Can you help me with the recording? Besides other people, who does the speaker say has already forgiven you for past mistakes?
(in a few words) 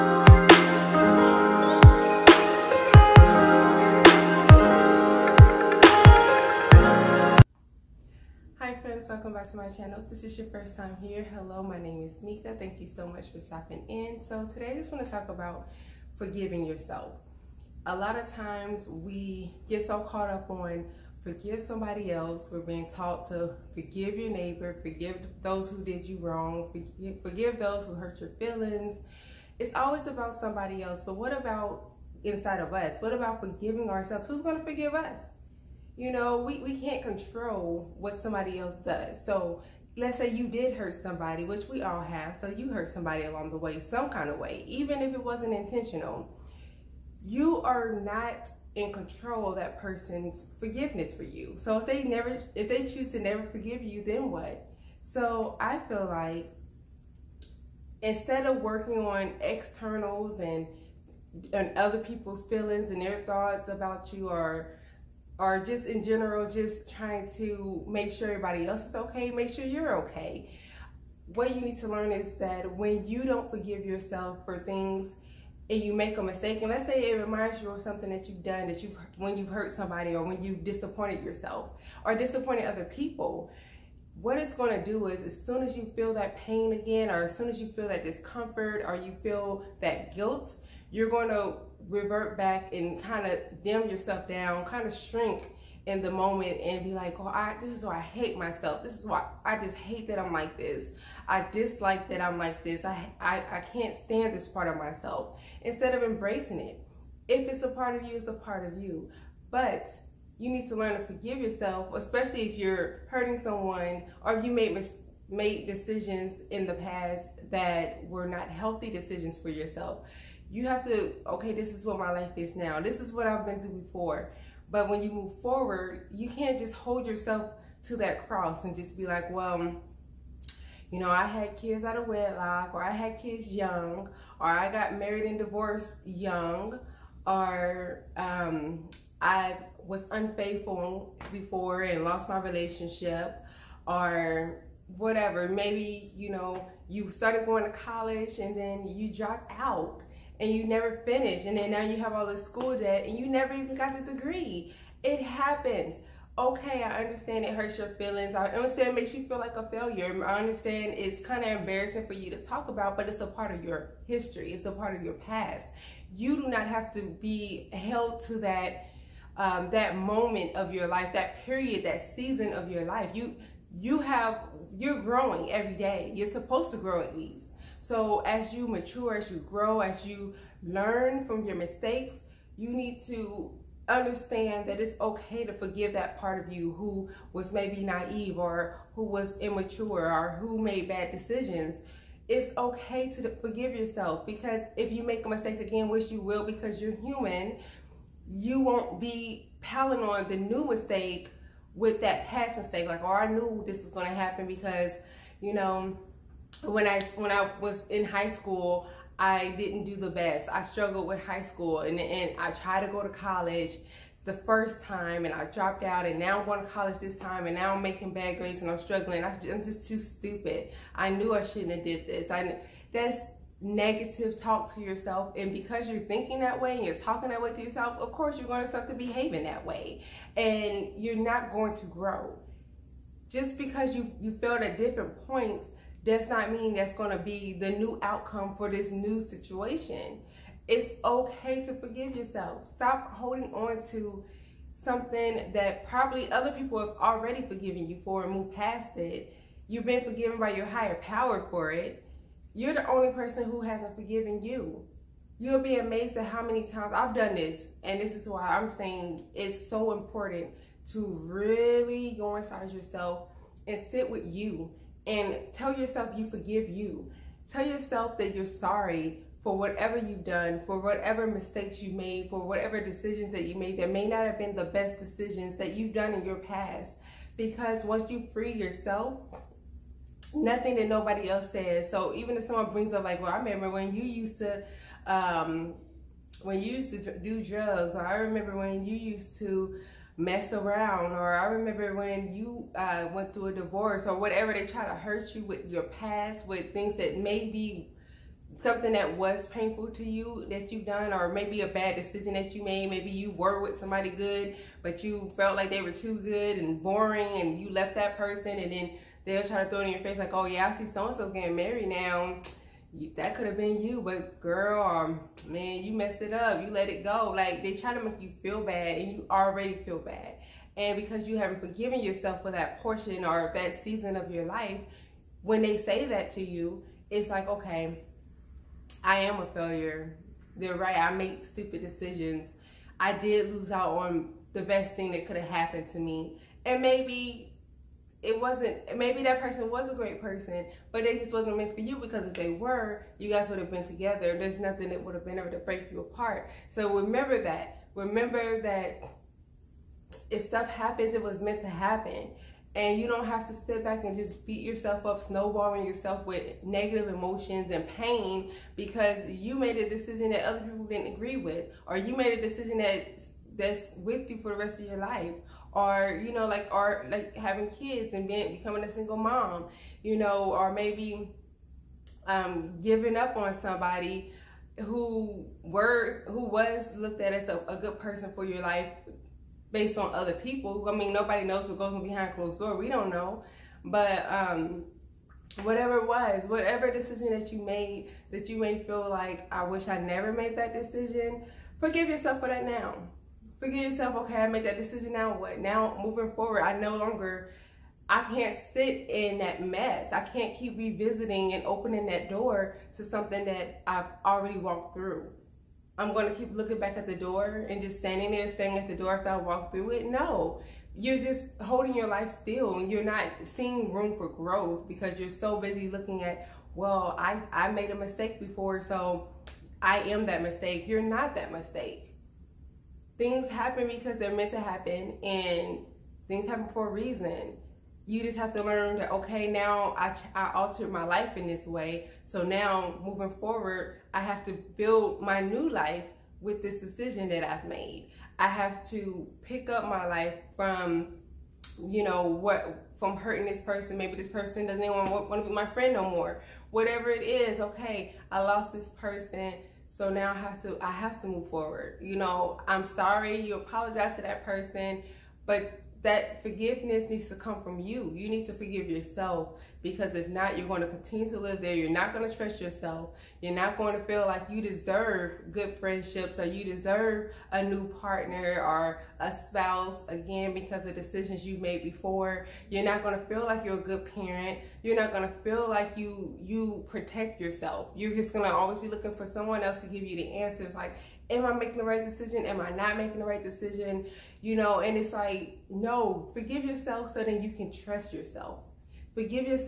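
your higher power.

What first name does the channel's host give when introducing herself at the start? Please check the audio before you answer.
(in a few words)
Meka.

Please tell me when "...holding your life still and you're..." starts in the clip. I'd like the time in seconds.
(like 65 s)
411 s.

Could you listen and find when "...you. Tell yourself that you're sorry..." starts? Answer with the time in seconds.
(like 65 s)
266 s.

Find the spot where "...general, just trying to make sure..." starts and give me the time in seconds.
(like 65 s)
66 s.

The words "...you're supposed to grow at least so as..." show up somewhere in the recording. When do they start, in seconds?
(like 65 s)
176 s.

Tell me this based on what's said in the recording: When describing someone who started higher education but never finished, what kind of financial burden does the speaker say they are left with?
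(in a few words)
school debt.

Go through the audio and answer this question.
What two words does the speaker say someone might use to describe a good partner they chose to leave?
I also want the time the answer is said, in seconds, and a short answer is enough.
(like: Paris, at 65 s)
good and boring, at 306 s.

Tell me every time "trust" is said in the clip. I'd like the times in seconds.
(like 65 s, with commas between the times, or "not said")
462 s, 487 s.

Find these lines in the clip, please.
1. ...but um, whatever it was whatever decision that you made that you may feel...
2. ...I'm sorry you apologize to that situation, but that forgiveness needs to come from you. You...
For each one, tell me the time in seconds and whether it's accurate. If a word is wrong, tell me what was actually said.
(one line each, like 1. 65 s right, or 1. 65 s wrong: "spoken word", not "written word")
1. 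383 s right
2. 452 s wrong: "person", not "situation".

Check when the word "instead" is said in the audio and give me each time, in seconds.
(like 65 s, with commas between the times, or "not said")
58 s, 105 s.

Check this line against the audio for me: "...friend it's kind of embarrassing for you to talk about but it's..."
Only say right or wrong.
wrong.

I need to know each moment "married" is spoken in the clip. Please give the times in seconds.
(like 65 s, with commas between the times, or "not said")
134 s, 311 s.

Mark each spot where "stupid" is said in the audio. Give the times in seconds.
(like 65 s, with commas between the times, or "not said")
219 s, 331 s.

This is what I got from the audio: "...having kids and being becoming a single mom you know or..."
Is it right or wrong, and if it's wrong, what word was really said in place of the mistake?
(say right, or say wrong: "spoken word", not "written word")
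right.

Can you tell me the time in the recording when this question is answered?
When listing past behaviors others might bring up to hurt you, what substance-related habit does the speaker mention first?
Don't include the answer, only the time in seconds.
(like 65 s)
287 s.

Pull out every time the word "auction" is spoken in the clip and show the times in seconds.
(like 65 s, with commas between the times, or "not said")
not said.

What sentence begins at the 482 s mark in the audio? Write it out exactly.
Am I not making the right decision?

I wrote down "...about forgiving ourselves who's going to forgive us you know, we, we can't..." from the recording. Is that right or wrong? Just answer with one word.
right.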